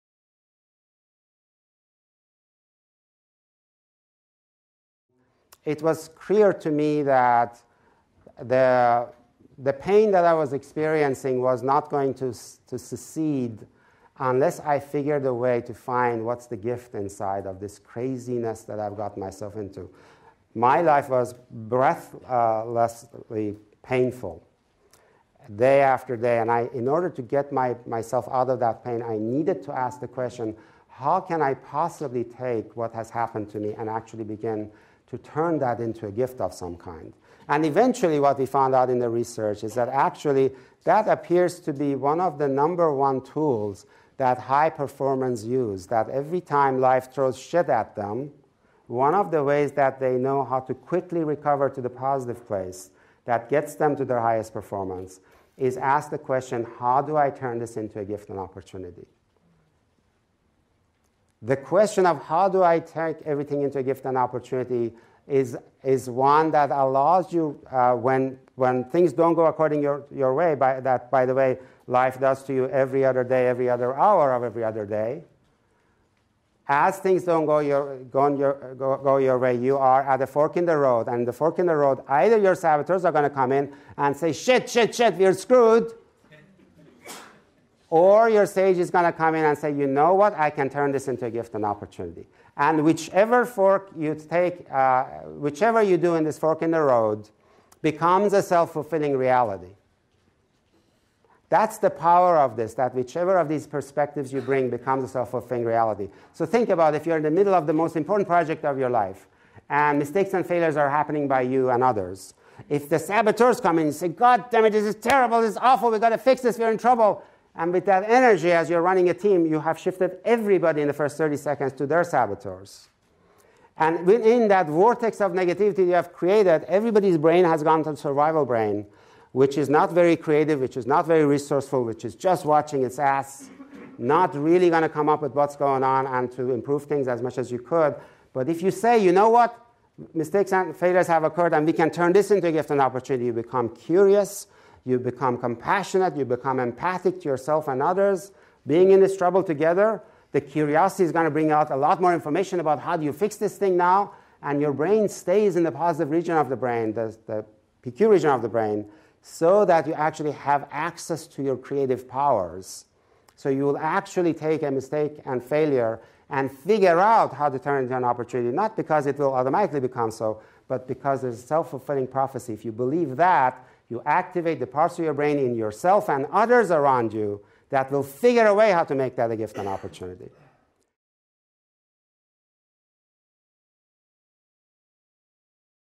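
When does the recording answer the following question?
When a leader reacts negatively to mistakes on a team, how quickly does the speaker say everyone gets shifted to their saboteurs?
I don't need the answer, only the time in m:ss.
2:01.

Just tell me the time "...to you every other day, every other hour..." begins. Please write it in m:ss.
1:12.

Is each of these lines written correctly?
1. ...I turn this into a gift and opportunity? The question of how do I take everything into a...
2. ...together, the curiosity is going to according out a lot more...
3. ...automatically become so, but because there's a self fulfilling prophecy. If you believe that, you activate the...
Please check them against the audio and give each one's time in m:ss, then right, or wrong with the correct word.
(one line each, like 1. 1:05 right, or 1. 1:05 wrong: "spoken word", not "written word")
1. 0:57 right
2. 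2:29 wrong: "bring", not "according"
3. 2:49 right.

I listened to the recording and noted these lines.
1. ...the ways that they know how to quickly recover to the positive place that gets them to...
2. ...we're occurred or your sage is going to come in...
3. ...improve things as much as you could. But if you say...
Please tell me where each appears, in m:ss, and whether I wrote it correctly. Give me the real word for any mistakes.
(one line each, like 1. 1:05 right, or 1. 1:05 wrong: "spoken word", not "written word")
1. 0:49 right
2. 1:25 wrong: "screwed", not "occurred"
3. 2:16 right.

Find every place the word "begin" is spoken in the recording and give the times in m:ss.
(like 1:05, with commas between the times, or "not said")
0:34.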